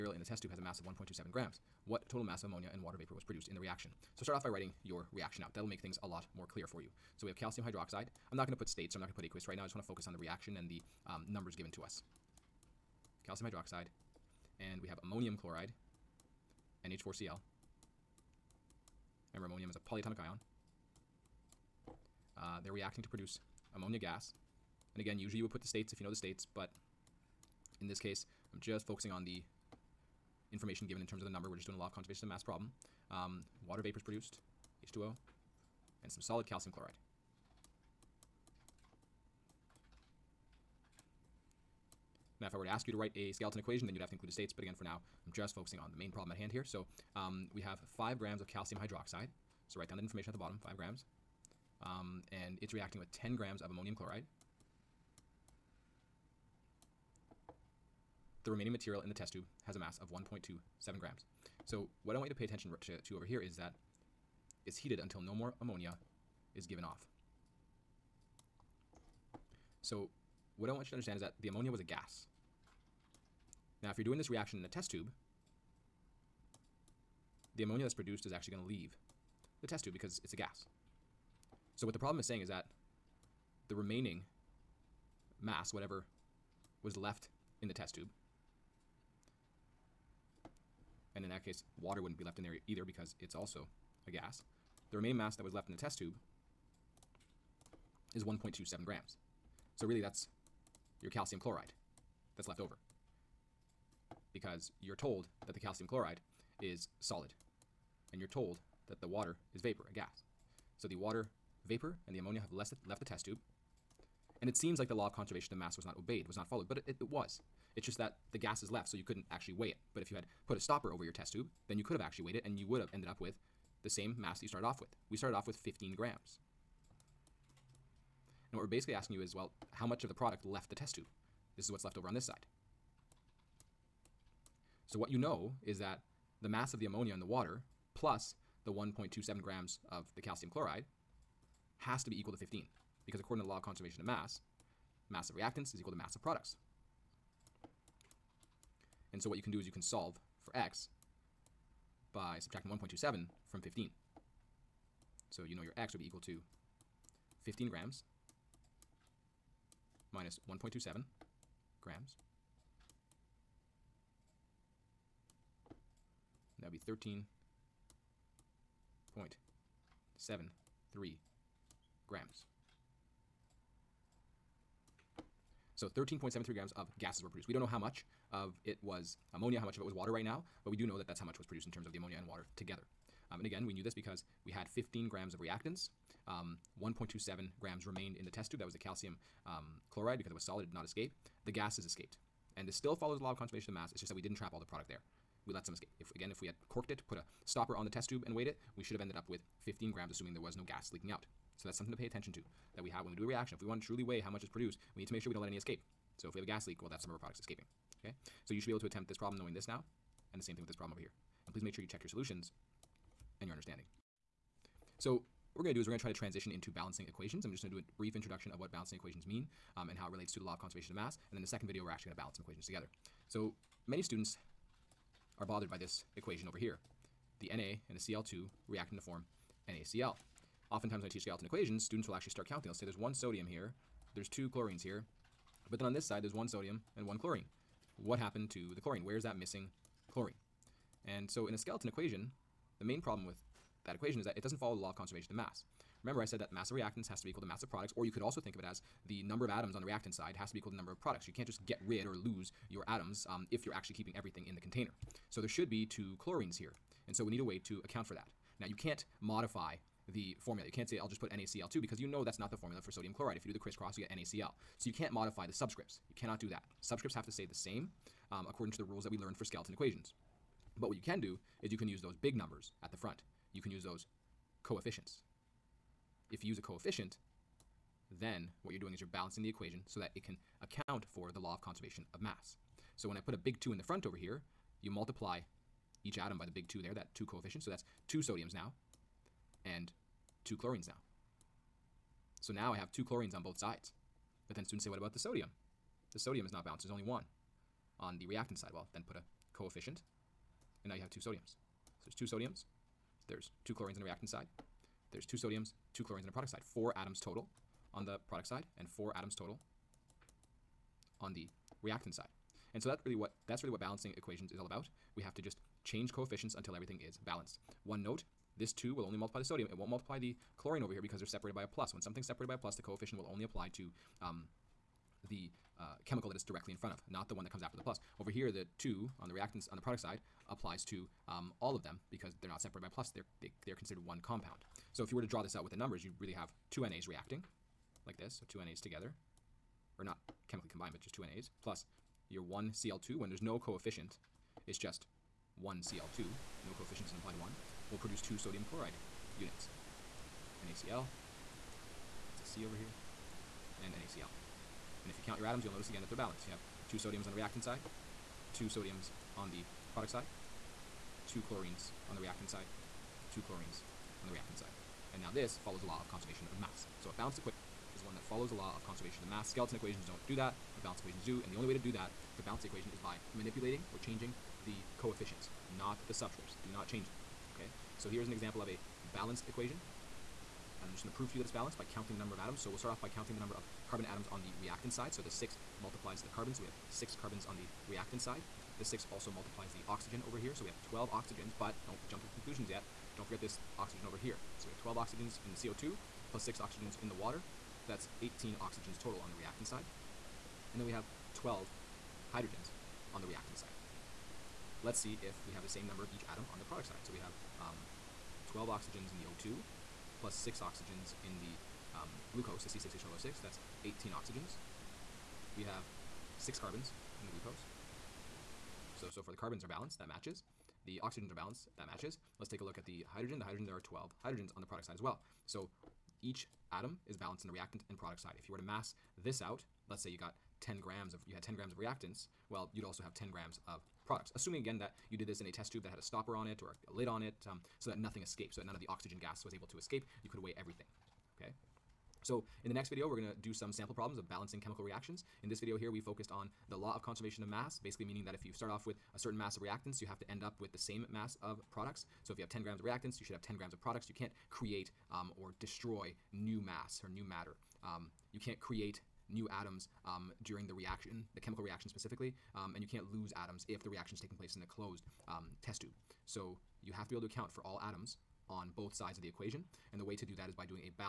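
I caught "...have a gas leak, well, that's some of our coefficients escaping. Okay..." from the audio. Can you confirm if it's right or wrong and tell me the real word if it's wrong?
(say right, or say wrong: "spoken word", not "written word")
wrong: "products", not "coefficients".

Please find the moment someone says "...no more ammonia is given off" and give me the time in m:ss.
1:05.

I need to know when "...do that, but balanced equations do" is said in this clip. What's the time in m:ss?
6:10.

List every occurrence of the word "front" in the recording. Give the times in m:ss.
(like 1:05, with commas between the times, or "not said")
4:32, 4:43, 5:26.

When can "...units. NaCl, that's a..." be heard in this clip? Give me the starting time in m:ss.
5:49.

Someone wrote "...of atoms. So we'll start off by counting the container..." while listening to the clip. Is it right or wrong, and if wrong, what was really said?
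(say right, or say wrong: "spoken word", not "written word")
wrong: "number", not "container".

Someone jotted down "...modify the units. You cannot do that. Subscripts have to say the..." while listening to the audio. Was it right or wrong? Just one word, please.
wrong.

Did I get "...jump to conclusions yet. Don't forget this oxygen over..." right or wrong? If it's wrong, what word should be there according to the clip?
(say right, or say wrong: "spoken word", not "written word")
right.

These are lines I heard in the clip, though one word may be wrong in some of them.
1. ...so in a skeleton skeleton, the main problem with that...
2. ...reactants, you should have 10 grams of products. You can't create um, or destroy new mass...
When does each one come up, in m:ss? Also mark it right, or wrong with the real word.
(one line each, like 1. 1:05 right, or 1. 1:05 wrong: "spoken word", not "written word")
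1. 4:01 wrong: "equation", not "skeleton"
2. 7:32 right.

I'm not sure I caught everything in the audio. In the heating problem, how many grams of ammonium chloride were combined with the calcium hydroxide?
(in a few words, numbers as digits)
10 grams.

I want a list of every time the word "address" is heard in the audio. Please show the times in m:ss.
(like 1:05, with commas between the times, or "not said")
not said.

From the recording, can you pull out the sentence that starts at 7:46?
So you have to be able to account for all atoms on both sides of the equation.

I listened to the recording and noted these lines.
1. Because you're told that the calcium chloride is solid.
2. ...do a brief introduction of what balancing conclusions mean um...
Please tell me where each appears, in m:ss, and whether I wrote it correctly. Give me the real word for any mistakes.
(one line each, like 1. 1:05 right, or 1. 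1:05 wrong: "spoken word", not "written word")
1. 1:44 right
2. 3:37 wrong: "equations", not "conclusions".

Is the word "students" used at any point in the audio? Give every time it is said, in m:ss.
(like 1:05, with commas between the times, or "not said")
3:44, 3:51, 4:54.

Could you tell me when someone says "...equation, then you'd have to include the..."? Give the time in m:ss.
0:43.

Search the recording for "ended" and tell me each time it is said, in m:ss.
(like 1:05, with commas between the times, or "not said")
2:02, 3:18.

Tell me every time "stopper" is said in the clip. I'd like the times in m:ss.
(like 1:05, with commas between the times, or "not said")
2:00, 3:17, 7:16.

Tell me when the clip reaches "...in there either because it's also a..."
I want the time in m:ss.
1:32.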